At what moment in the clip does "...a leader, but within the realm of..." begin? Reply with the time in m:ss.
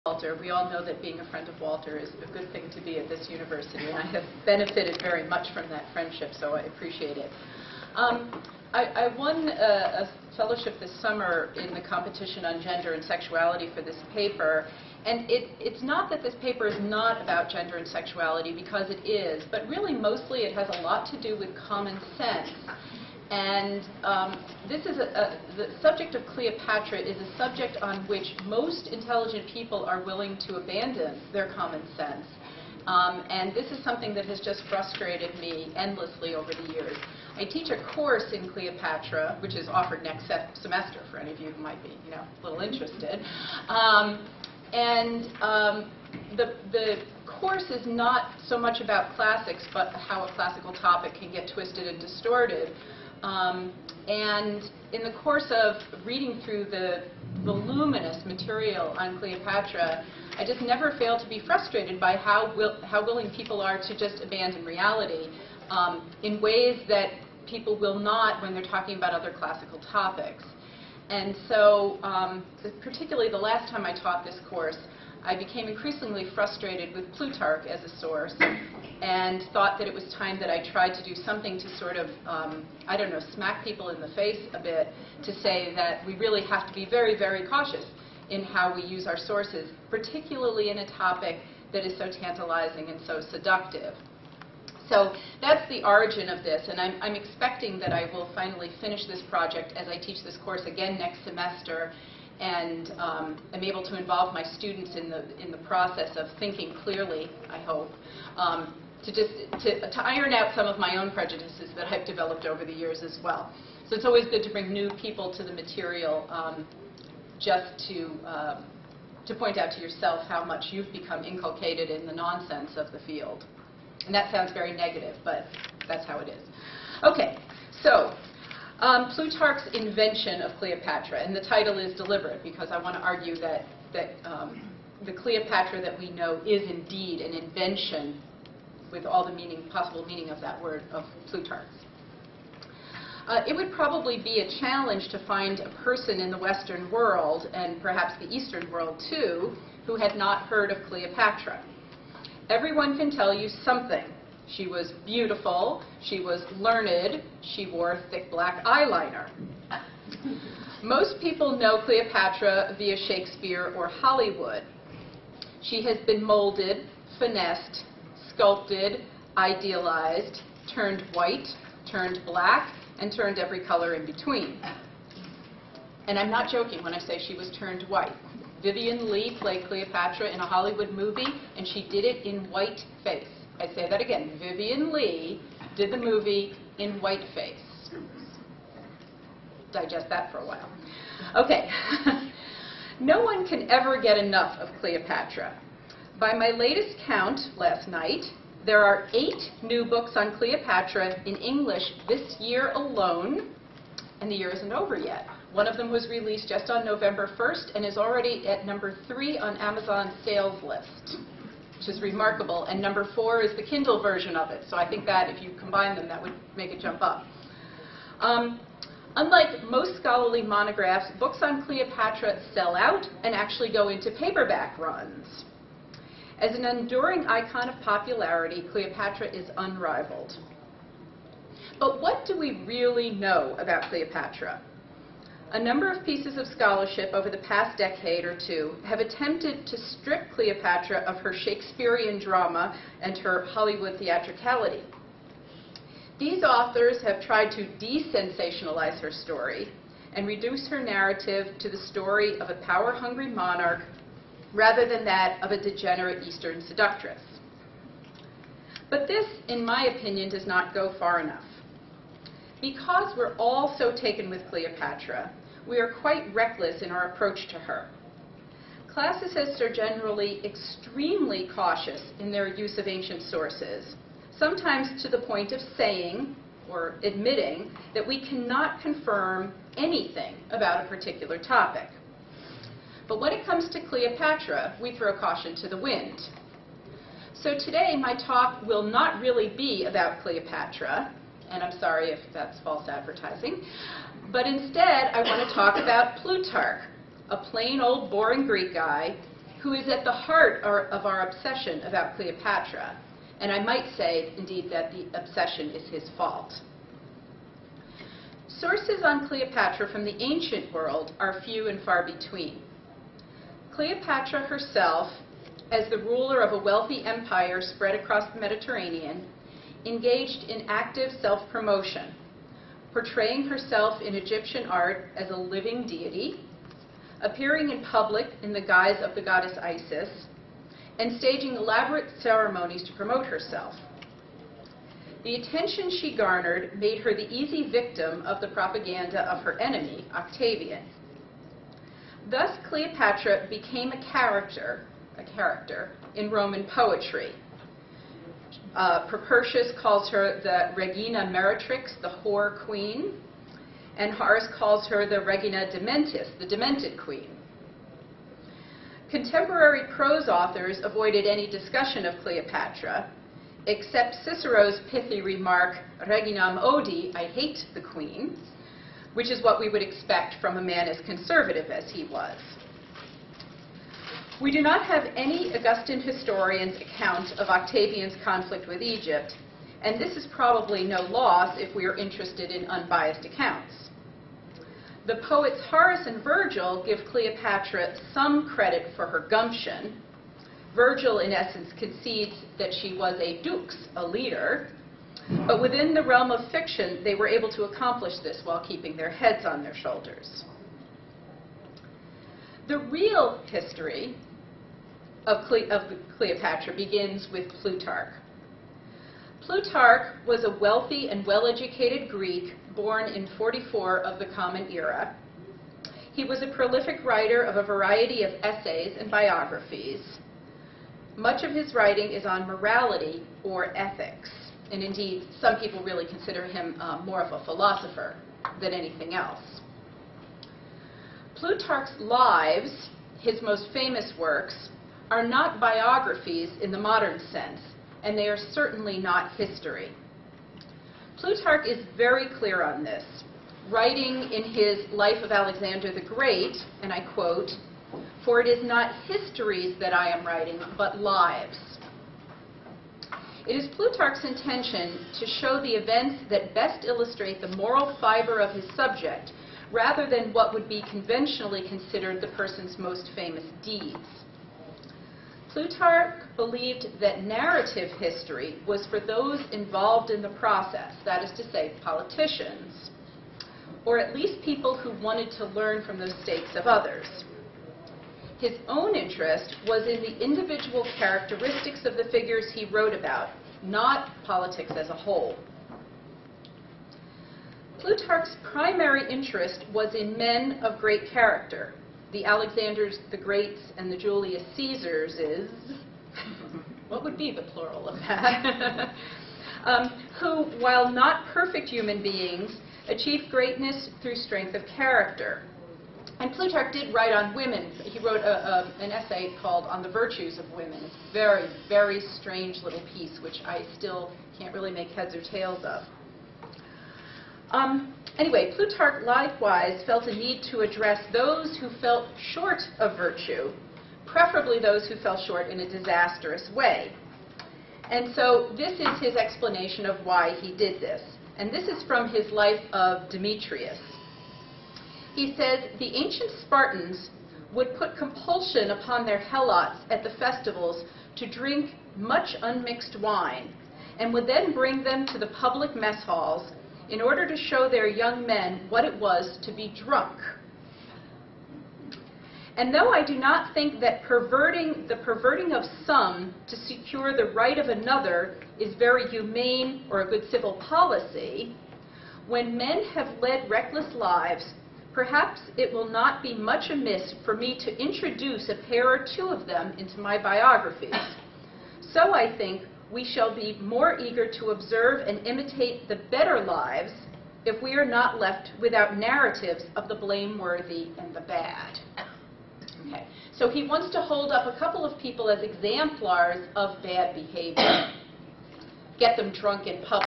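6:33.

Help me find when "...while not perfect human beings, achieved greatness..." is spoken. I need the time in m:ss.
8:20.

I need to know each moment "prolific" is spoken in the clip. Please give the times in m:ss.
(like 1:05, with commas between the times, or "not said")
6:56.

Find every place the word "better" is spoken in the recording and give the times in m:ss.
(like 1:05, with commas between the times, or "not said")
9:36.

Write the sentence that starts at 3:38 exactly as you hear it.
Um, unlike most scholarly monographs, books on Cleopatra sell out and actually go into paperback runs.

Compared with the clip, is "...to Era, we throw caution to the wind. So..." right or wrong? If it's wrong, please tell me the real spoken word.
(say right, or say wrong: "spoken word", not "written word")
wrong: "Cleopatra", not "Era".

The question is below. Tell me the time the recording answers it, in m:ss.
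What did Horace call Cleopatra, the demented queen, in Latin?
5:55.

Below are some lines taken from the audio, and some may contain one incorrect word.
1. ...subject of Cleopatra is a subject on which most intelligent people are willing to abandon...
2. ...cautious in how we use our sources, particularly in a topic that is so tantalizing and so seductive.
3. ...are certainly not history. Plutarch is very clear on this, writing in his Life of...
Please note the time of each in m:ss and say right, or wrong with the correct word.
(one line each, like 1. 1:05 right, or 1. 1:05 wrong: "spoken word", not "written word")
1. 0:25 right
2. 1:27 right
3. 7:18 right.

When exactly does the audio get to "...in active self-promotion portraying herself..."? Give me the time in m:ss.
5:20.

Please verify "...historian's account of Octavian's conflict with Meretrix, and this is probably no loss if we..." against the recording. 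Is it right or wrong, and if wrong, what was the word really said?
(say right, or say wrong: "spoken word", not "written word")
wrong: "Egypt", not "Meretrix".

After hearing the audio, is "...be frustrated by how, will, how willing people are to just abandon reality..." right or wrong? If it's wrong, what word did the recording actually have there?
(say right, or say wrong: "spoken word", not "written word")
right.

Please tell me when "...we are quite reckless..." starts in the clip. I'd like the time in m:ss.
4:25.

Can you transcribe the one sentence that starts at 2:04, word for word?
And that sounds very negative, but that's how it is.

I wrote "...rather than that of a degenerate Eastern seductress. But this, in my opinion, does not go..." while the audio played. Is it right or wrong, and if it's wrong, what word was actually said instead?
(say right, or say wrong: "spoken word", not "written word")
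right.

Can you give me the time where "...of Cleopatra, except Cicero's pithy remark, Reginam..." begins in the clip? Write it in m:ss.
6:02.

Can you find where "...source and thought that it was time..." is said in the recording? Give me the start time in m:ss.
1:17.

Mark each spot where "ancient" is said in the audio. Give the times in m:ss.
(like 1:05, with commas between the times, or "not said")
4:32, 5:10, 8:55.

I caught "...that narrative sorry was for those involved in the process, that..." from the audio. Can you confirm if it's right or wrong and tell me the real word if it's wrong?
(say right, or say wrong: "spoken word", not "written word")
wrong: "history", not "sorry".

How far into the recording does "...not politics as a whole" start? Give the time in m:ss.
8:03.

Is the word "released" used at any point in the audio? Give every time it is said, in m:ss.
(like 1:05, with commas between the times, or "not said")
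3:26.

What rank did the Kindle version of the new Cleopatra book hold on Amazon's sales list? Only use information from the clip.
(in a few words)
4.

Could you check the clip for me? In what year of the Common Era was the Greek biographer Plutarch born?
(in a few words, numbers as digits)
44.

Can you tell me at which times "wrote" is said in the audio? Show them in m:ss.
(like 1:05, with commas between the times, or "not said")
8:02, 8:27.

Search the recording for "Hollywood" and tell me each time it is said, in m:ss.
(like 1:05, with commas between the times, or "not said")
2:43, 3:00, 4:03.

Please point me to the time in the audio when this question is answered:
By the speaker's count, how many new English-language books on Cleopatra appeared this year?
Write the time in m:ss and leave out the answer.
3:19.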